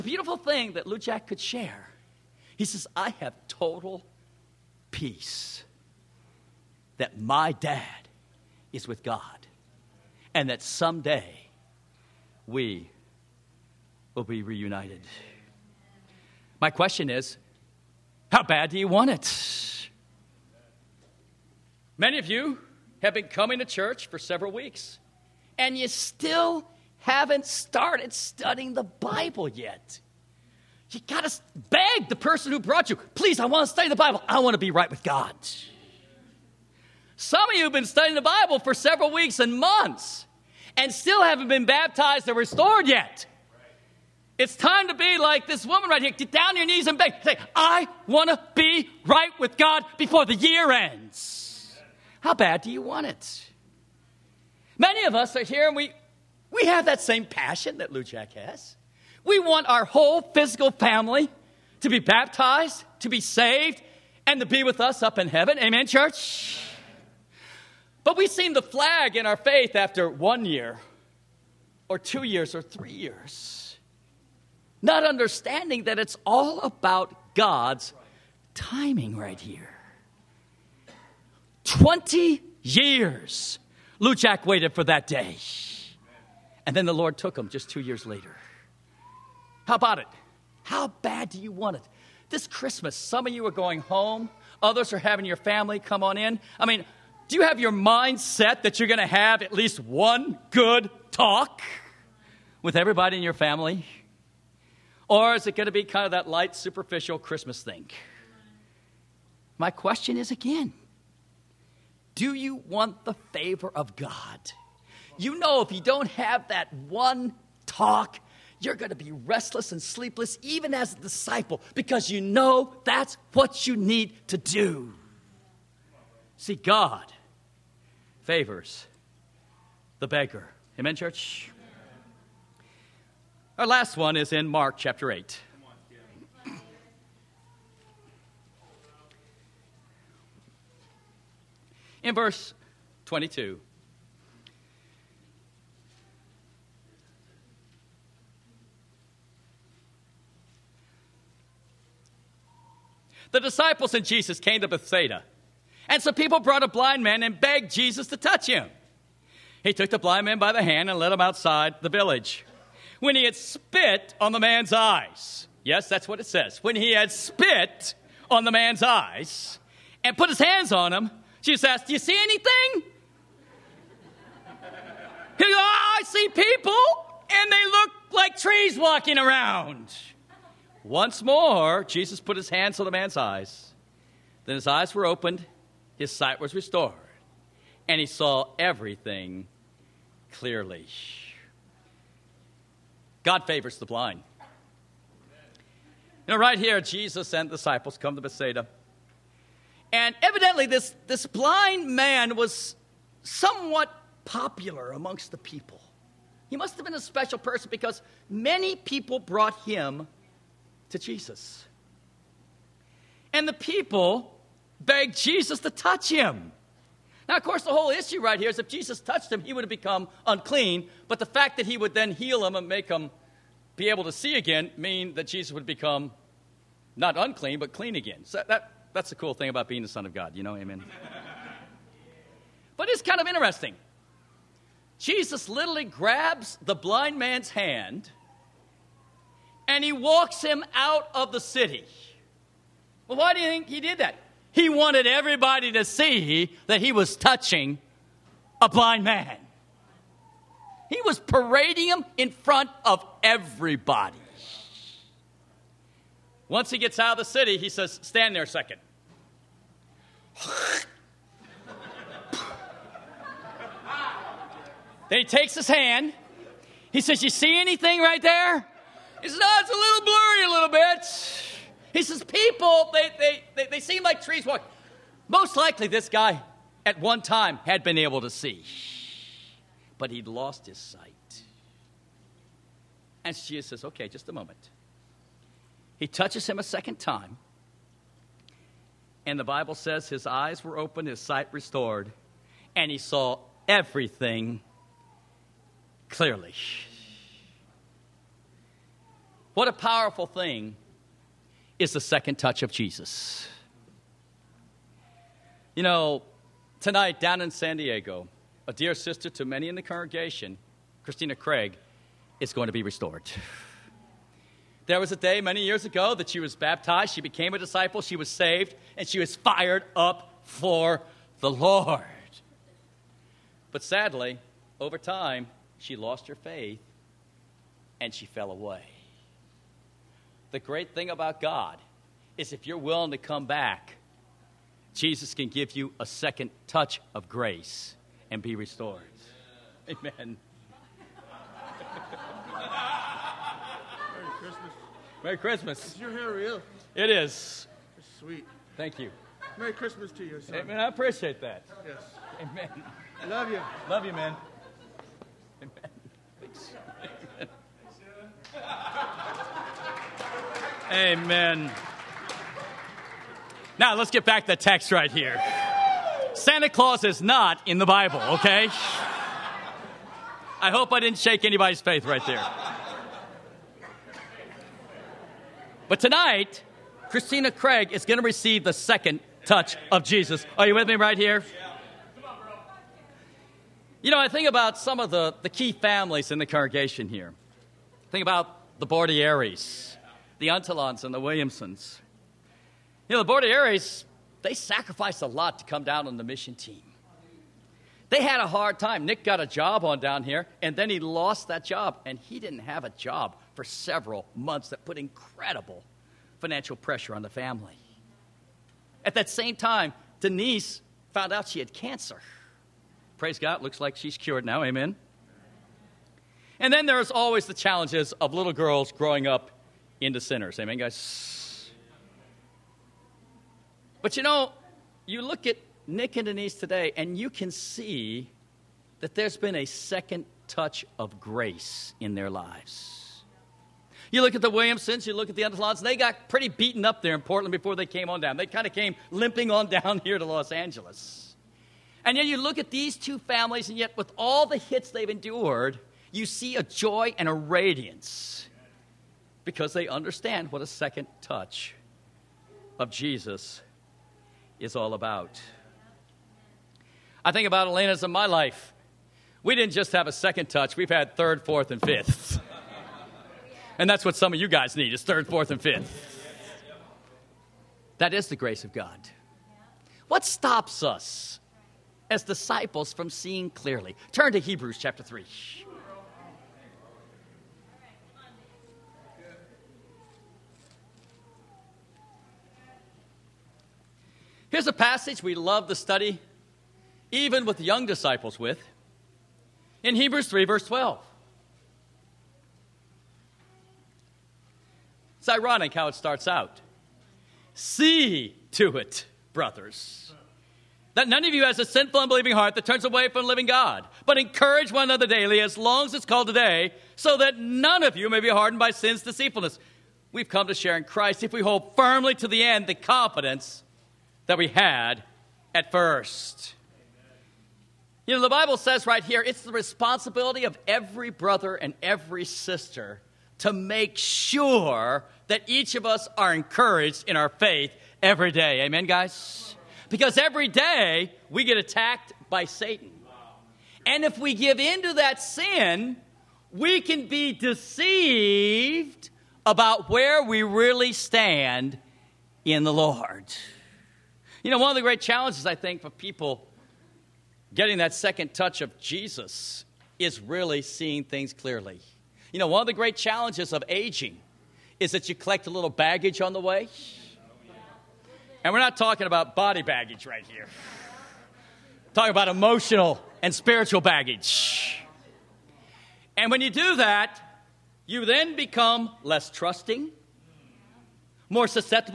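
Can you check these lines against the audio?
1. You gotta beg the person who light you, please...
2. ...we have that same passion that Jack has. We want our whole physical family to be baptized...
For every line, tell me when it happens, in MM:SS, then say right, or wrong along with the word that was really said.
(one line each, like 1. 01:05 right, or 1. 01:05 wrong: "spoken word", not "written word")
1. 00:30 wrong: "brought", not "light"
2. 00:56 right.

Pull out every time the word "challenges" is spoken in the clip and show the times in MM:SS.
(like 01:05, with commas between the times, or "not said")
06:57, 09:05, 09:12.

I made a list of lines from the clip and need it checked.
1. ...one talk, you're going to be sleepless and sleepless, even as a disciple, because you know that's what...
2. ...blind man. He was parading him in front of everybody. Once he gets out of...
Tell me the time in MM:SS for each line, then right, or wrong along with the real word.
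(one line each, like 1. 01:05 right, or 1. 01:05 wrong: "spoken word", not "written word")
1. 01:56 wrong: "restless", not "sleepless"
2. 04:08 right.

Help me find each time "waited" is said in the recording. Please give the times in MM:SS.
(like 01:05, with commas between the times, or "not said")
01:24.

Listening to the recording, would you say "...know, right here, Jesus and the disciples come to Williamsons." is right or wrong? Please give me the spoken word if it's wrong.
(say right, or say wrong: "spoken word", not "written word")
wrong: "Bethsaida", not "Williamsons".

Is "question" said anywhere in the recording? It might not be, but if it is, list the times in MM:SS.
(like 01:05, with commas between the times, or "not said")
00:16, 01:49.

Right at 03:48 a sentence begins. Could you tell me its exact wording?
So that, that's the cool thing about being the Son of God, you know?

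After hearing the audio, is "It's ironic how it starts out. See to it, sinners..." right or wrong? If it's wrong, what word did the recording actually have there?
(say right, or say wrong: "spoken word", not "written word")
wrong: "brothers", not "sinners".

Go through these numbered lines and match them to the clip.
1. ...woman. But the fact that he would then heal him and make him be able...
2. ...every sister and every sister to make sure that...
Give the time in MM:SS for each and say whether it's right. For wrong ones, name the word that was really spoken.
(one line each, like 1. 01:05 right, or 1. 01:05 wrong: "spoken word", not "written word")
1. 03:40 wrong: "unclean", not "woman"
2. 08:40 wrong: "brother", not "sister".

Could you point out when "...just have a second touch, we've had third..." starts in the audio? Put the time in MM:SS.
07:39.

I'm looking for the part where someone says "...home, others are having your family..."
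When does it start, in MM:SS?
01:33.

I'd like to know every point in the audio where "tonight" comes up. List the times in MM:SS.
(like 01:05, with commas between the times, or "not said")
05:06, 06:16.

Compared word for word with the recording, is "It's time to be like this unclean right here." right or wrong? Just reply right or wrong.
wrong.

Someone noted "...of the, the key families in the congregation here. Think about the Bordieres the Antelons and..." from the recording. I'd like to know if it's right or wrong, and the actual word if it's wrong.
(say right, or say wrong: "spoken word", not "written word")
right.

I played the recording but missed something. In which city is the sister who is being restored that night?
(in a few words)
San Diego.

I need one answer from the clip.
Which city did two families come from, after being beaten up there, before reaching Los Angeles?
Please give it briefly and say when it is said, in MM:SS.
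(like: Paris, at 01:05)
Portland, at 07:17.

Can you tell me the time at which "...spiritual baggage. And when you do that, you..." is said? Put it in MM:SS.
09:23.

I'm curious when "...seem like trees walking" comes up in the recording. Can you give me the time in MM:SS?
04:33.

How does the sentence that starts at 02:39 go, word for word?
He took the blind man by the hand and led him outside the village.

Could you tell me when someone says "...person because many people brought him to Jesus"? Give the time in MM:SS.
03:27.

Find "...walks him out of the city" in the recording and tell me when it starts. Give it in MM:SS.
03:59.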